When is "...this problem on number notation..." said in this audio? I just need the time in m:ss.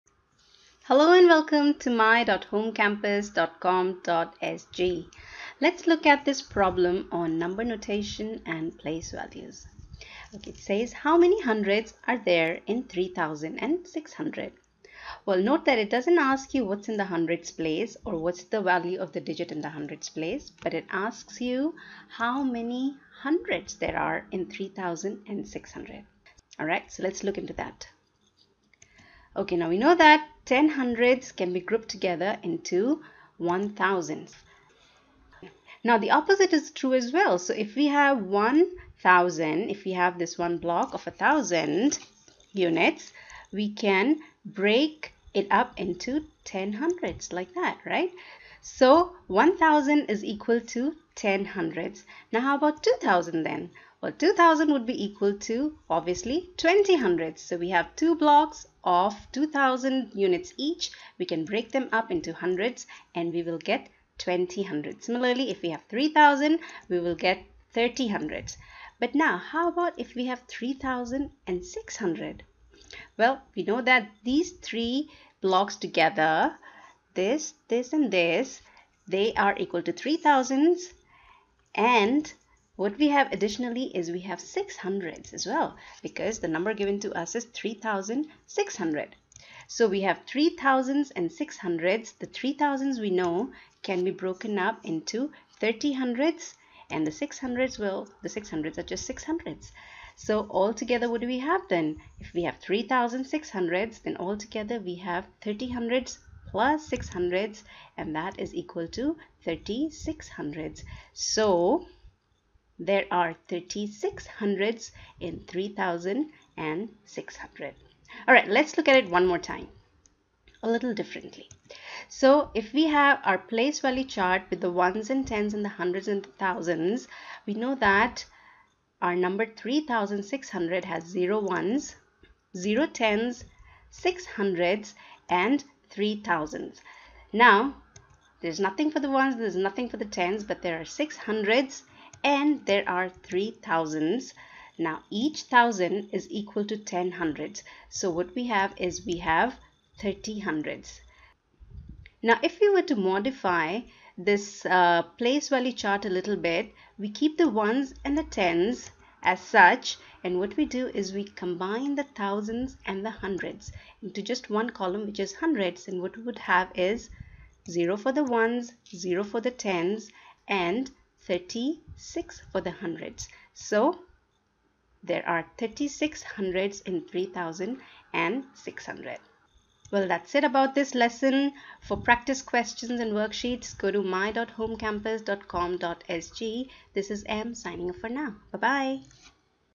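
0:06.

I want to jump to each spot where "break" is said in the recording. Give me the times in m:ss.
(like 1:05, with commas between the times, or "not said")
0:44, 1:01.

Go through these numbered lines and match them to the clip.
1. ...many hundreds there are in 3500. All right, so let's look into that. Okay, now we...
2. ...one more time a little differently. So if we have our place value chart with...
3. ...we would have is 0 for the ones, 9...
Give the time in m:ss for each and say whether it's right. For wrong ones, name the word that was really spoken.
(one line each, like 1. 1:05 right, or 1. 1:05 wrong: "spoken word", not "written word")
1. 0:22 wrong: "3600", not "3500"
2. 1:59 right
3. 2:46 wrong: "0", not "9".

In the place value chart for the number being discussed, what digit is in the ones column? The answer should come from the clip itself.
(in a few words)
0.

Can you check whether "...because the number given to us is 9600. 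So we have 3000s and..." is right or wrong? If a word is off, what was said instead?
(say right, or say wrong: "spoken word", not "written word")
wrong: "3600", not "9600".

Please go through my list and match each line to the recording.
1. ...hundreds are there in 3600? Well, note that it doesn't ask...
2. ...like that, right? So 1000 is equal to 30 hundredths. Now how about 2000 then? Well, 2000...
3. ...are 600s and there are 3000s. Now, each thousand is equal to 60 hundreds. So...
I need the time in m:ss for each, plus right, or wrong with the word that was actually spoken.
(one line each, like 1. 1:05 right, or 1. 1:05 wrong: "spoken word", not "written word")
1. 0:11 right
2. 0:47 wrong: "10", not "30"
3. 2:20 wrong: "10", not "60".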